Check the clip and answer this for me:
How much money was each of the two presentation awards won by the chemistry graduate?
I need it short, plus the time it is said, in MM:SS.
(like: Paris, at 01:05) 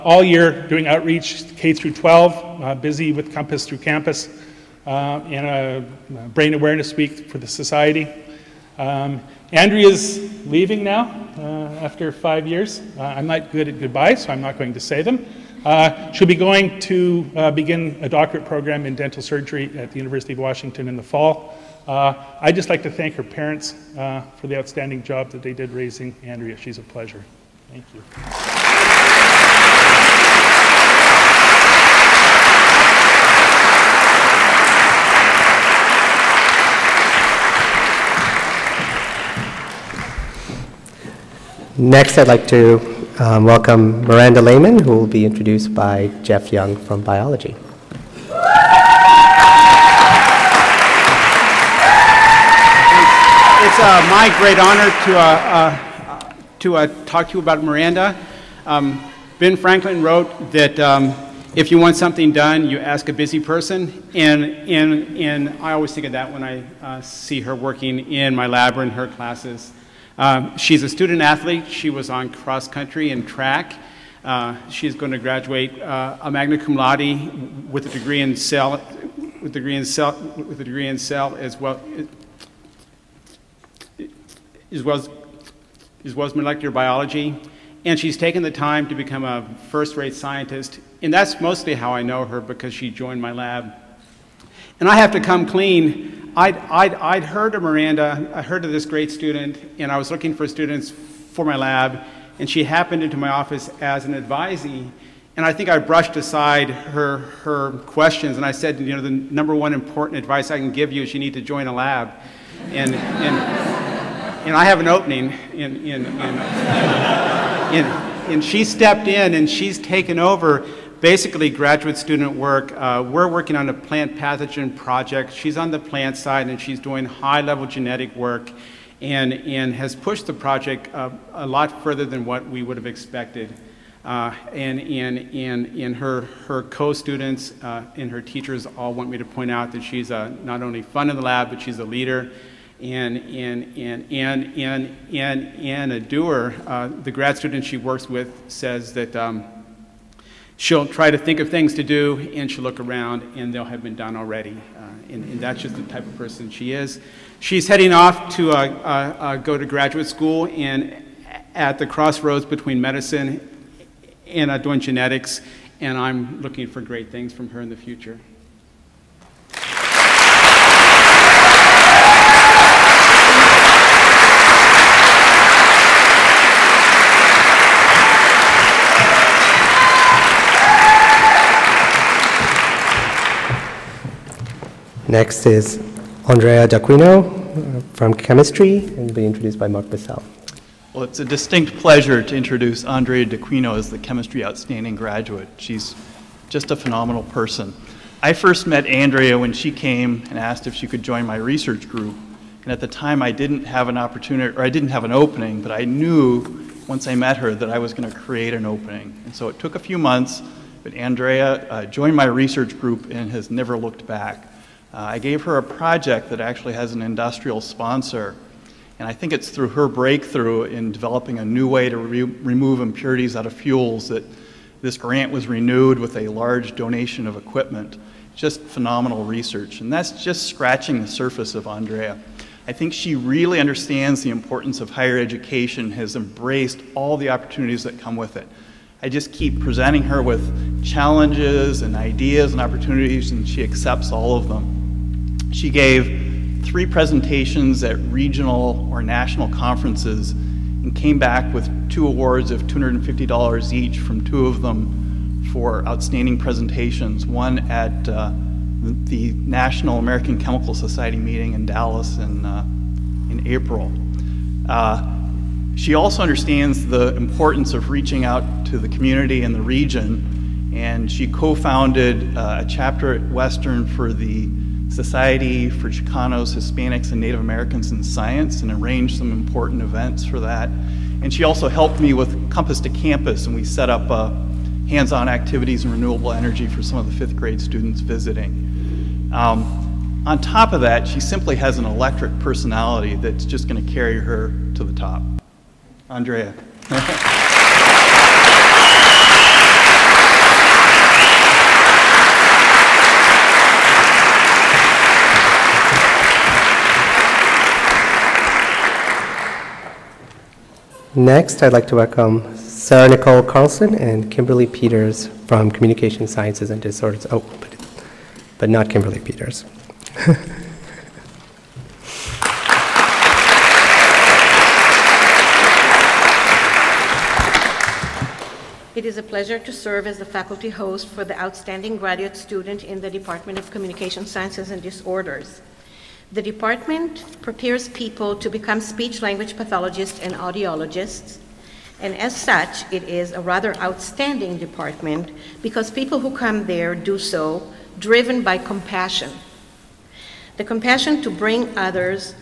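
$250, at 04:12.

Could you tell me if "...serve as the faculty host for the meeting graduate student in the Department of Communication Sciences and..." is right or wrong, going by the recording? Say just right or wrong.
wrong.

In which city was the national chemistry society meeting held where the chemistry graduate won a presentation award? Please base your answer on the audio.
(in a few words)
Dallas.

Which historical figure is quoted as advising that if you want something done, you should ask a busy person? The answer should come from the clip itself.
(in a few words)
Ben Franklin.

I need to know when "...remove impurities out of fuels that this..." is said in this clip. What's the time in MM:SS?
03:42.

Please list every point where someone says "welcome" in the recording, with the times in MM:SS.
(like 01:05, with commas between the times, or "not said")
00:43, 05:11.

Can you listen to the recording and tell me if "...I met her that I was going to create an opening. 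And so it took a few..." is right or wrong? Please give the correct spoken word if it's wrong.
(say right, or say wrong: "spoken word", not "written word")
right.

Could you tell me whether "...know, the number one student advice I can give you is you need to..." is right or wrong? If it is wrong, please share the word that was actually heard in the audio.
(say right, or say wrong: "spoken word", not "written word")
wrong: "important", not "student".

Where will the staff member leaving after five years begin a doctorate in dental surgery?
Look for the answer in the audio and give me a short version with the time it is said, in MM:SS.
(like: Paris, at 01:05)
University of Washington, at 00:19.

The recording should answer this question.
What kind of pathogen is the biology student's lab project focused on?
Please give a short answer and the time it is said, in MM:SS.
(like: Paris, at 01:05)
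Plant pathogen, at 02:03.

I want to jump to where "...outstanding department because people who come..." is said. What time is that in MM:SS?
05:43.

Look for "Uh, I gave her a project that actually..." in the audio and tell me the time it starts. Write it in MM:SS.
03:34.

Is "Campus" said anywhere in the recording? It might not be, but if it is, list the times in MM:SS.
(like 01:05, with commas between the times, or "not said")
00:03, 04:42.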